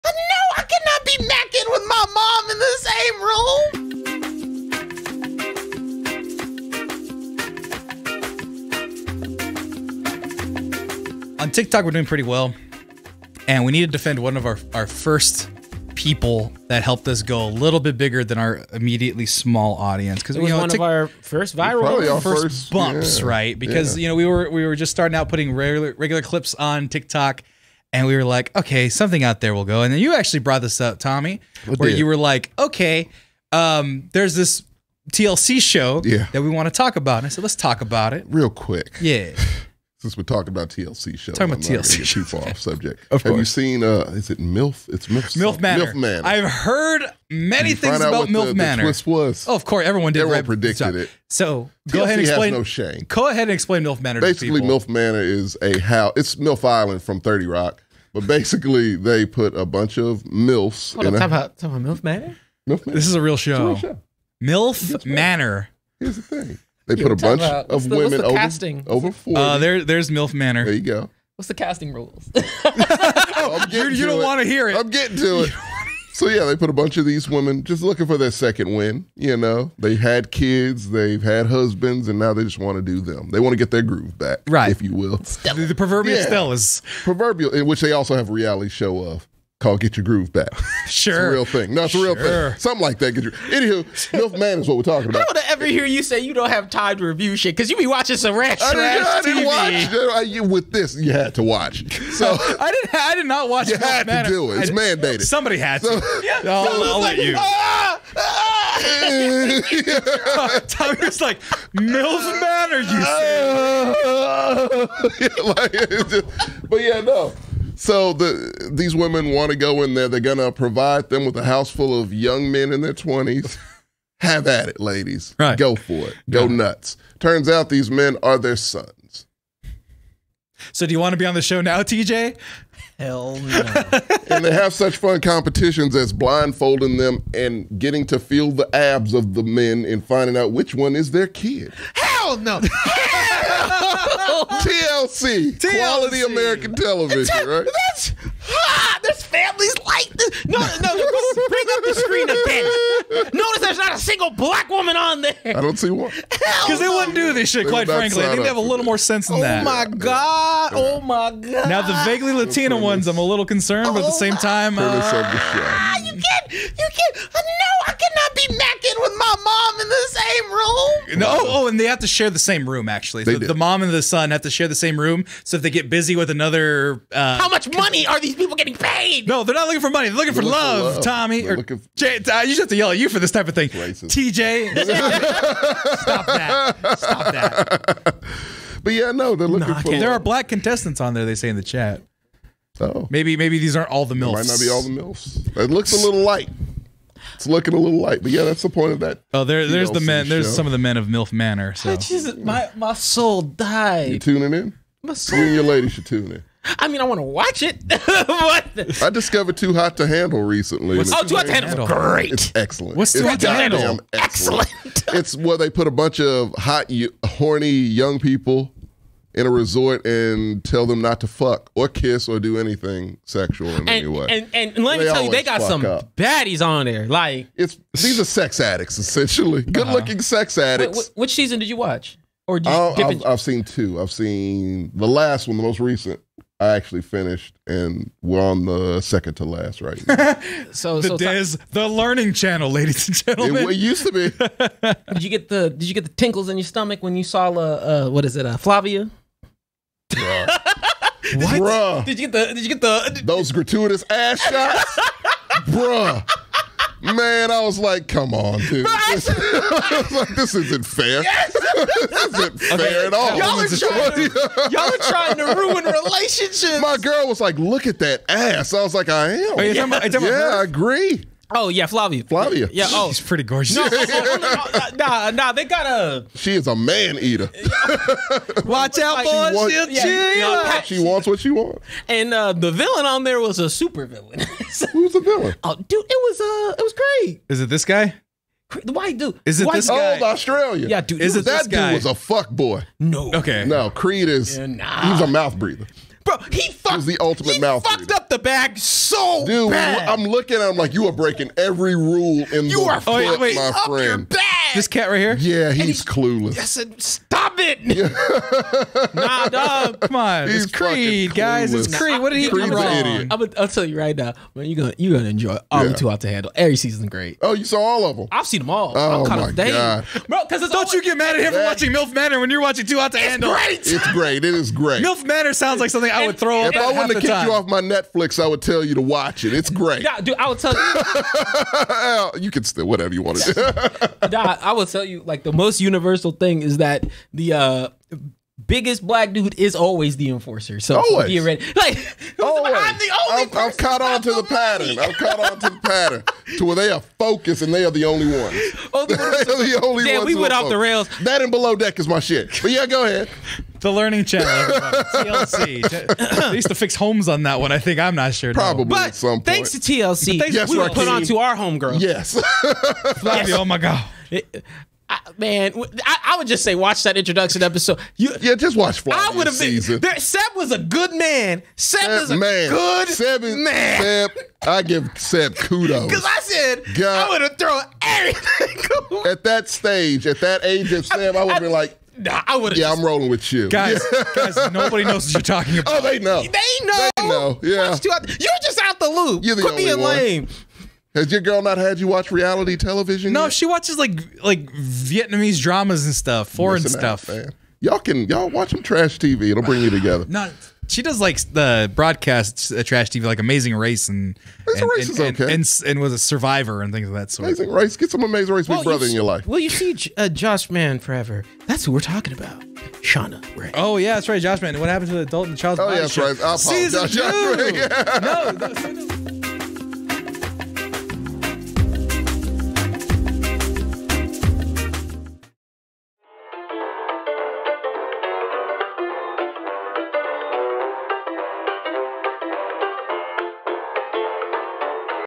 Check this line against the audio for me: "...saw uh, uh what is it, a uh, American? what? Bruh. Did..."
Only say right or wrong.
wrong.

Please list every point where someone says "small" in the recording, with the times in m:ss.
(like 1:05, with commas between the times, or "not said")
0:19.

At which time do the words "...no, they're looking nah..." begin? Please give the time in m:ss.
3:09.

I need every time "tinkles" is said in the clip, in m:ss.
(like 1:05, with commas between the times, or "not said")
4:06.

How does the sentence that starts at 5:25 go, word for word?
MILF Manor sounds like something I would throw up.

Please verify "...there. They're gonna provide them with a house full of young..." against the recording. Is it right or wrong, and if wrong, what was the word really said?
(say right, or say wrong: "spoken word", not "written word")
right.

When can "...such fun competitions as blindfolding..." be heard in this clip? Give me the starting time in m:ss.
2:14.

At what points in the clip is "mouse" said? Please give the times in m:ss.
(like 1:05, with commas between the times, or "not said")
not said.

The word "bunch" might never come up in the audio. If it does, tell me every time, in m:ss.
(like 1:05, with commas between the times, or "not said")
0:59, 1:07, 1:16, 3:35.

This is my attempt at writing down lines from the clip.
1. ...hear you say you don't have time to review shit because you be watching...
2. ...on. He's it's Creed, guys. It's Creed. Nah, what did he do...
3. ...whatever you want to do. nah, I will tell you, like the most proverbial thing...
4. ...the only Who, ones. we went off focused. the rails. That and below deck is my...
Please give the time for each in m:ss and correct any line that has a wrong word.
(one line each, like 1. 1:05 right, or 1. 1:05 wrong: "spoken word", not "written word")
1. 1:35 right
2. 5:10 right
3. 5:32 wrong: "universal", not "proverbial"
4. 5:49 wrong: "Damn", not "Who".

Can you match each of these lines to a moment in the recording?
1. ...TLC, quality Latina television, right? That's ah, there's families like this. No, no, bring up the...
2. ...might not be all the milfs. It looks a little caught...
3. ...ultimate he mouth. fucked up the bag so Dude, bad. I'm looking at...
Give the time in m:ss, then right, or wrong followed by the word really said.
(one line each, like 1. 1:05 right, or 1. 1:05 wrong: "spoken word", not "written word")
1. 2:25 wrong: "American", not "Latina"
2. 3:14 wrong: "light", not "caught"
3. 4:57 right.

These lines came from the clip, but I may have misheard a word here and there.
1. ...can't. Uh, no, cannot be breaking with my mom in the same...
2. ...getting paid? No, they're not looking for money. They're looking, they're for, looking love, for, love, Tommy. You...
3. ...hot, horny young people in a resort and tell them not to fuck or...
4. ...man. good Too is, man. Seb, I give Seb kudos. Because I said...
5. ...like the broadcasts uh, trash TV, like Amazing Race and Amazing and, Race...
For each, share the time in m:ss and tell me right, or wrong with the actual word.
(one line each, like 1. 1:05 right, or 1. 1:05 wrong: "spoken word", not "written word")
1. 2:46 wrong: "macking", not "breaking"
2. 2:58 right
3. 3:36 right
4. 6:12 wrong: "Seb", not "Too"
5. 6:41 right.